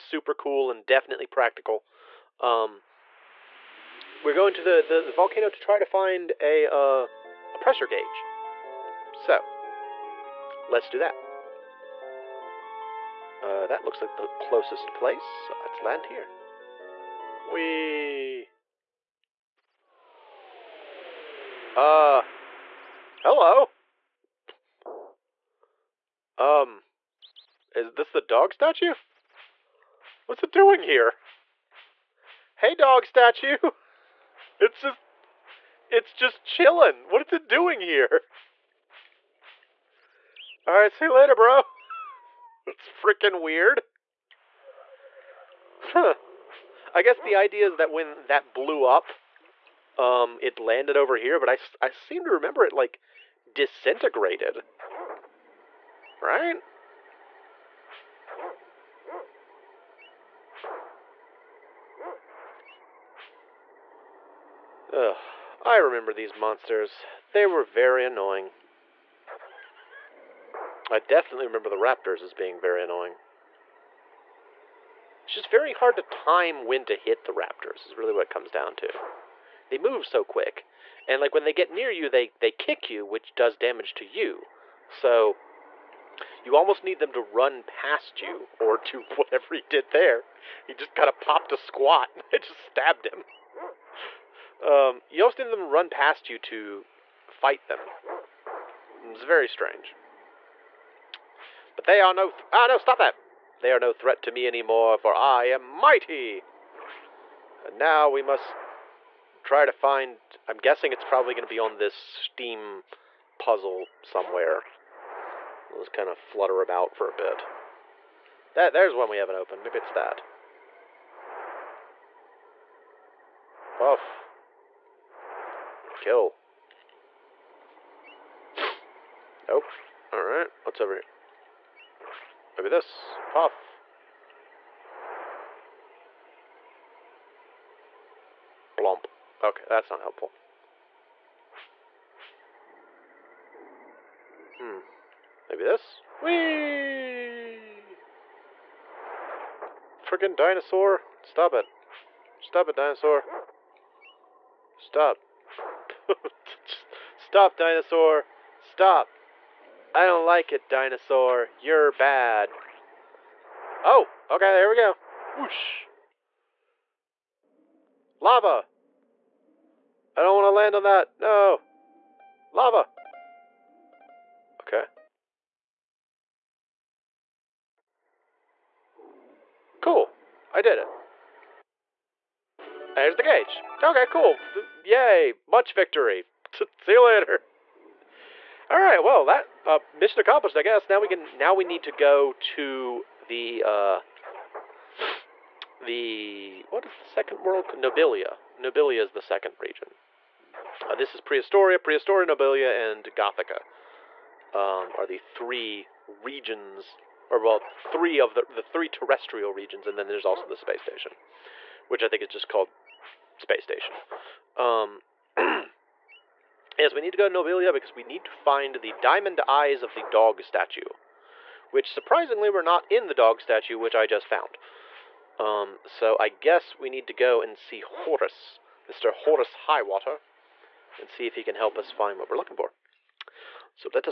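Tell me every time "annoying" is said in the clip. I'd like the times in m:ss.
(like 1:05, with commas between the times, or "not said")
1:08, 1:12.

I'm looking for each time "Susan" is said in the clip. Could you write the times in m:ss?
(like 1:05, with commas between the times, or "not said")
not said.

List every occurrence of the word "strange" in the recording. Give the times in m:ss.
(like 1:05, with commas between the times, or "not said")
1:39.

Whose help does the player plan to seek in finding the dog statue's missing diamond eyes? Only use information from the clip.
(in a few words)
Horus Highwater.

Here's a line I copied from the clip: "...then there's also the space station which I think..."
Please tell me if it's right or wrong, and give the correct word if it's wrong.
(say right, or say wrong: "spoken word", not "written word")
right.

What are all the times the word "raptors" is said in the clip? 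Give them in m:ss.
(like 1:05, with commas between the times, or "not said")
1:11, 1:17.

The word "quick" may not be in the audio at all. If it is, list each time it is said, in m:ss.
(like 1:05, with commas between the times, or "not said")
1:20.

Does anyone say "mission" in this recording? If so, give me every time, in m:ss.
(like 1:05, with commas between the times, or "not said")
3:09.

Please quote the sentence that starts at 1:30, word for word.
He just kind of popped a squat.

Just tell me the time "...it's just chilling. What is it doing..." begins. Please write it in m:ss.
0:35.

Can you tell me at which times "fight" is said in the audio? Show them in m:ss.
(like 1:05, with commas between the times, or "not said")
1:37.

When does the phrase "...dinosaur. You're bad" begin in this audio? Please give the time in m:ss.
2:40.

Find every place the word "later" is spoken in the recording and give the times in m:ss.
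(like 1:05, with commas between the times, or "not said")
0:41, 3:07.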